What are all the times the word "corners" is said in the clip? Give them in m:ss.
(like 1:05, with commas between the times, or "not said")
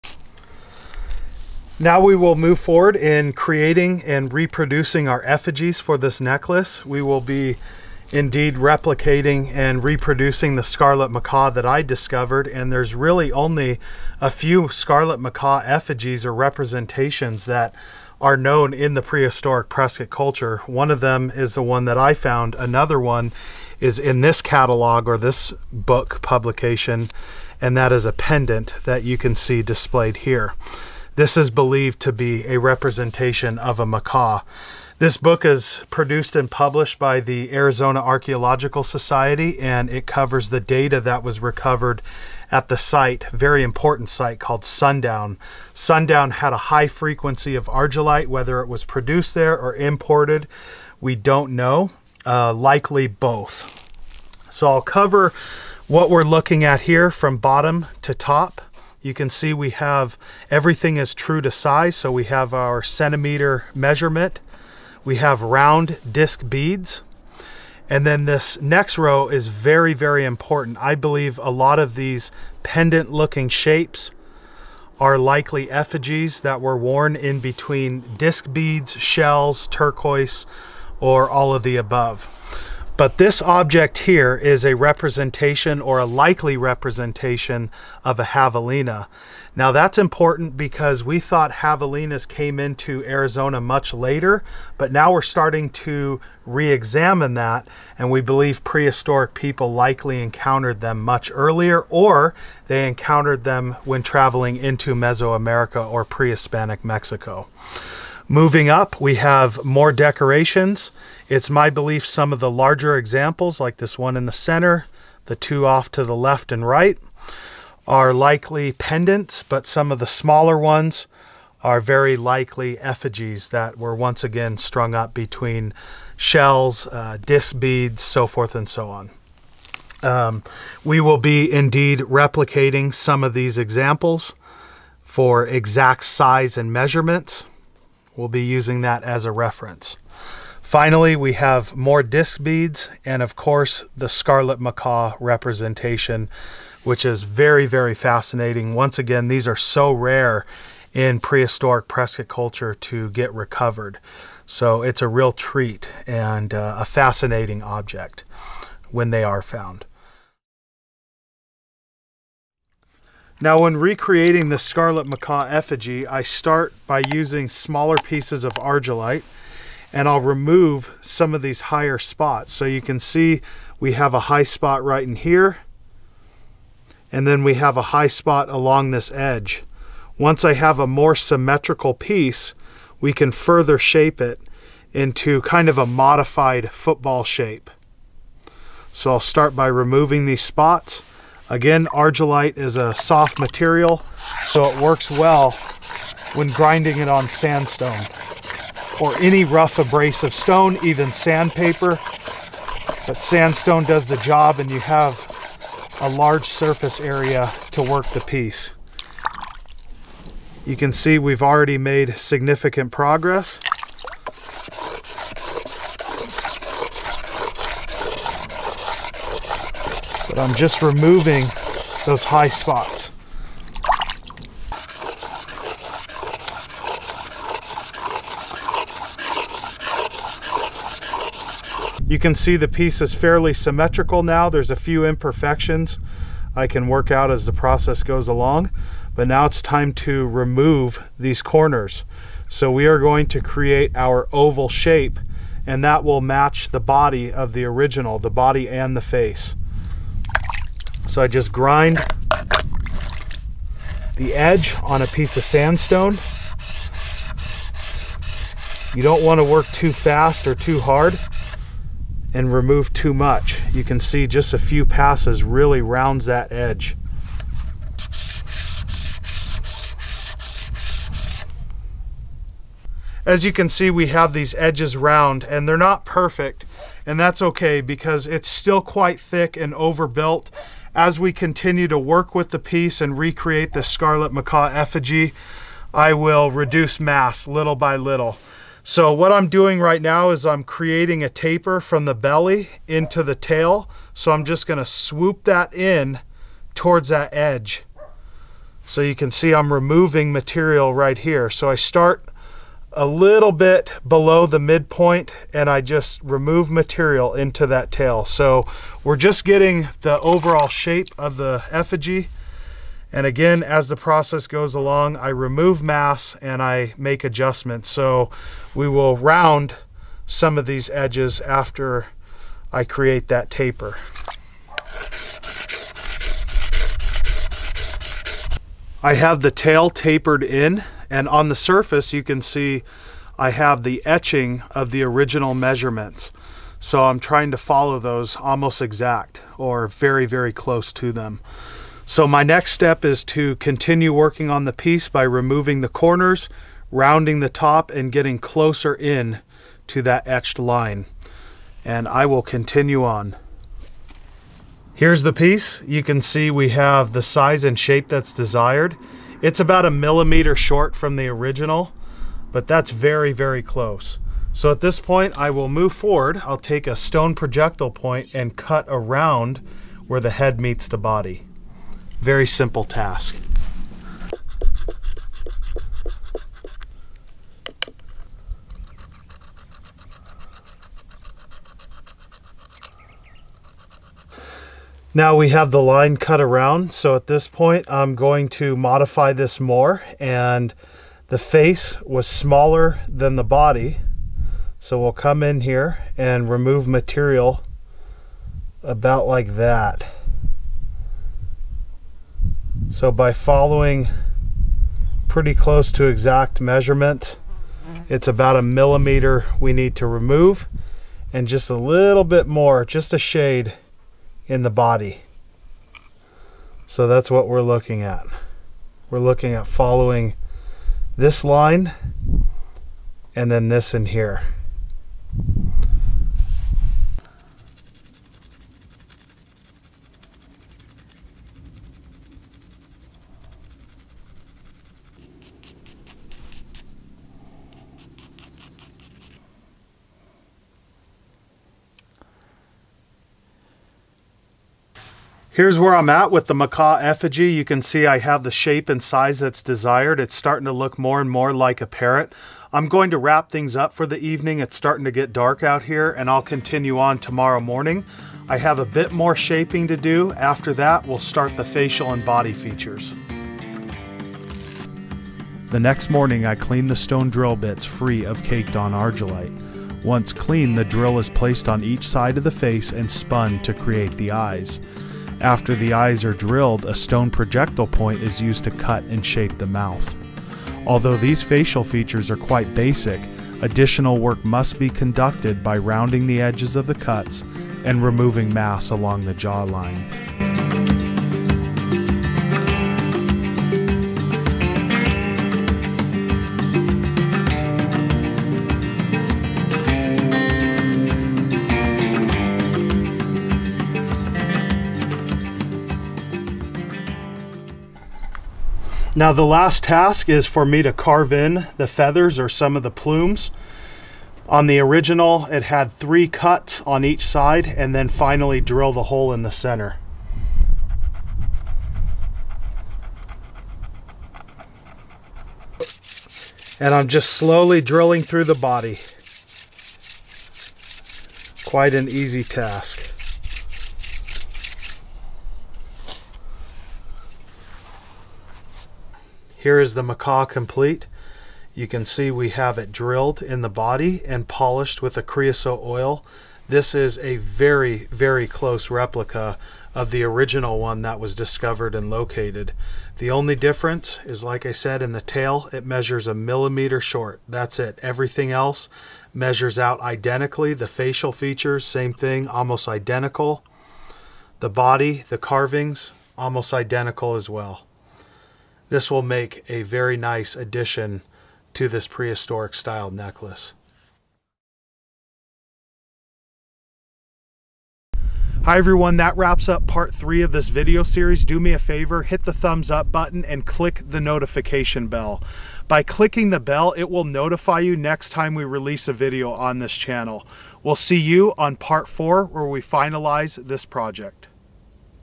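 4:01, 5:45.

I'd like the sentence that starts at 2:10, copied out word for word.
Um, we will be indeed replicating some of these examples for exact size and measurements.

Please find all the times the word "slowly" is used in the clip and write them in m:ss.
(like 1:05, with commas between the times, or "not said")
8:47.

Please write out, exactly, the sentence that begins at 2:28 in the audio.
Once again, these are so rare in prehistoric Prescott culture to get recovered.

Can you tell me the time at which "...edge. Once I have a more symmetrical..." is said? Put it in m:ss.
2:59.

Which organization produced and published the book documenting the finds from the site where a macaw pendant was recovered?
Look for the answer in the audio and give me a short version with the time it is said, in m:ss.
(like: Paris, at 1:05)
Arizona Archaeological Society, at 0:37.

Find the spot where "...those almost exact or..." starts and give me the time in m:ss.
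5:37.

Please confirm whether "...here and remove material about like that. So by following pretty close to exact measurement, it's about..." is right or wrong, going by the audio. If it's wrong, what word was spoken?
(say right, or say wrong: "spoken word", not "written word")
right.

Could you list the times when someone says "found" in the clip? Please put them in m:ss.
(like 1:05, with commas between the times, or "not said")
0:22, 2:39.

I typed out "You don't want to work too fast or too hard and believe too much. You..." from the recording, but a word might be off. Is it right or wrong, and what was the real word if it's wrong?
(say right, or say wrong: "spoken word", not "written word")
wrong: "remove", not "believe".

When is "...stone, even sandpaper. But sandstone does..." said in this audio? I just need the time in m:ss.
3:20.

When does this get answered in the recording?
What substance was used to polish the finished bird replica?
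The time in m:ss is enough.
9:05.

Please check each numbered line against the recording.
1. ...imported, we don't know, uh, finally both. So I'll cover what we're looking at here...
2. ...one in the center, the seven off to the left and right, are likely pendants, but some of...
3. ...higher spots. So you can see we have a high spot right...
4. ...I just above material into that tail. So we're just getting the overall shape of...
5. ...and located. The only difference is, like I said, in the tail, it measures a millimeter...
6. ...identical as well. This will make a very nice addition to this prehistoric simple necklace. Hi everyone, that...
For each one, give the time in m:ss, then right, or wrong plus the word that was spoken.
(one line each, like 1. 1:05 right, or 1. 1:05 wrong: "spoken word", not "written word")
1. 0:49 wrong: "likely", not "finally"
2. 1:53 wrong: "two", not "seven"
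3. 2:51 right
4. 5:05 wrong: "remove", not "above"
5. 9:11 right
6. 9:26 wrong: "style", not "simple".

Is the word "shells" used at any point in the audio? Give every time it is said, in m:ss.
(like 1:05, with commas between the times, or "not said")
1:18, 2:06.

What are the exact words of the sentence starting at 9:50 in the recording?
We'll see you on part four where we finalize this project.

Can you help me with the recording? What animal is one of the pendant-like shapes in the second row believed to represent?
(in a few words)
Javelina.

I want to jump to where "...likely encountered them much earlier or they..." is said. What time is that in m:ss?
1:39.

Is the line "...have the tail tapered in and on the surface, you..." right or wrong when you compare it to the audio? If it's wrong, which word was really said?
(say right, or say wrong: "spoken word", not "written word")
right.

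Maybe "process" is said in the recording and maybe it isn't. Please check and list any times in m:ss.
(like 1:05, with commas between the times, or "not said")
3:57, 5:13.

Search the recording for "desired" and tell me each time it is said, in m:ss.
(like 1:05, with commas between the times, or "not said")
5:58, 7:29.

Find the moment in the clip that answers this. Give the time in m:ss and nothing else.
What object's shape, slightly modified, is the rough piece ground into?
3:06.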